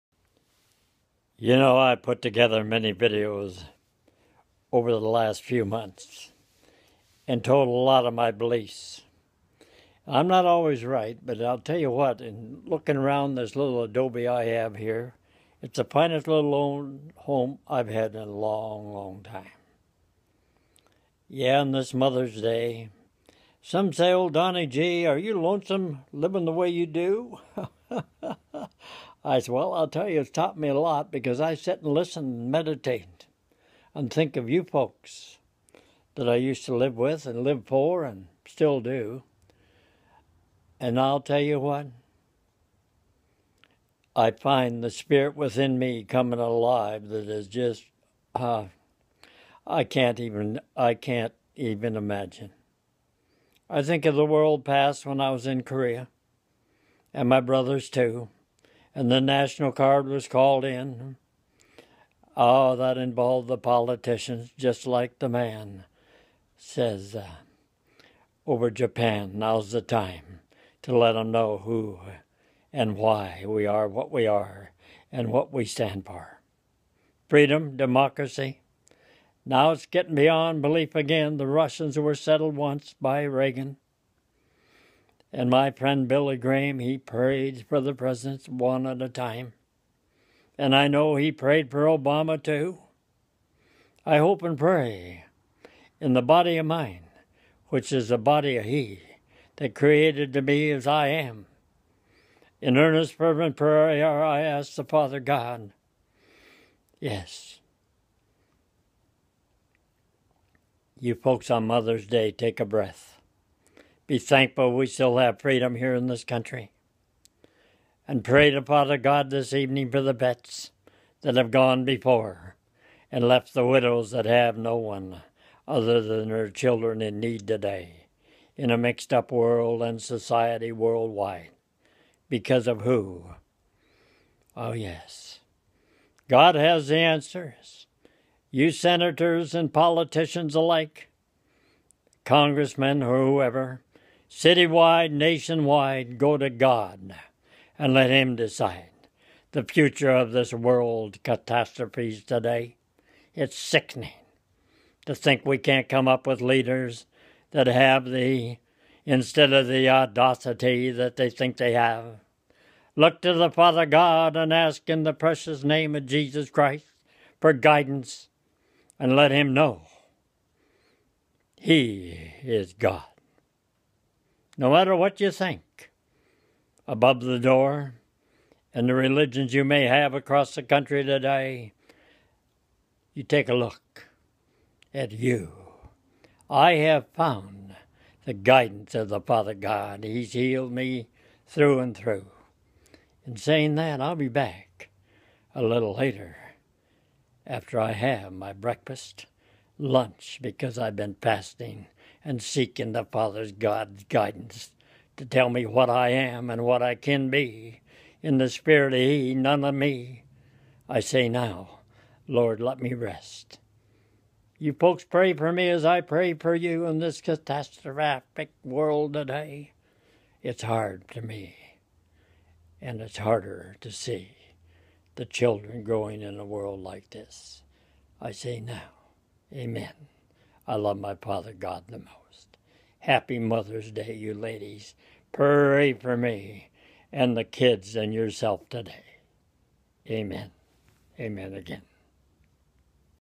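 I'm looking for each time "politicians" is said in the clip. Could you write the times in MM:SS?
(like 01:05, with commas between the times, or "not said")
01:03, 02:19.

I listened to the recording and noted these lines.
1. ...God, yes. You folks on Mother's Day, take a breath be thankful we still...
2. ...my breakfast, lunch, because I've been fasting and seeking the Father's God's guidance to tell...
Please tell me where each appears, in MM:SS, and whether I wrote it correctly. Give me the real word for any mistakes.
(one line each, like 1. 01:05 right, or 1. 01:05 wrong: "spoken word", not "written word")
1. 01:45 right
2. 03:18 right.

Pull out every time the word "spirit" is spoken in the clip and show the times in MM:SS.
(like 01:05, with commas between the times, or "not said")
00:44, 03:28.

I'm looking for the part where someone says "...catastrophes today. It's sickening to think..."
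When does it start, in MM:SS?
02:31.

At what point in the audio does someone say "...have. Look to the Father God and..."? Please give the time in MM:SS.
02:41.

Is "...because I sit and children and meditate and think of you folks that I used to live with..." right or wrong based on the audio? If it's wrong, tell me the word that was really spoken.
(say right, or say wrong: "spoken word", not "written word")
wrong: "listen", not "children".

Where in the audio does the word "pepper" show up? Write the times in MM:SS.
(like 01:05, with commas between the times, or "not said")
not said.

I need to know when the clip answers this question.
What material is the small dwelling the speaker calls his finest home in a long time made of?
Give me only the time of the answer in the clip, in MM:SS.
00:13.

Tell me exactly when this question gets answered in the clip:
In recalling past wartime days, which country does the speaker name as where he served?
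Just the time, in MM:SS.
00:55.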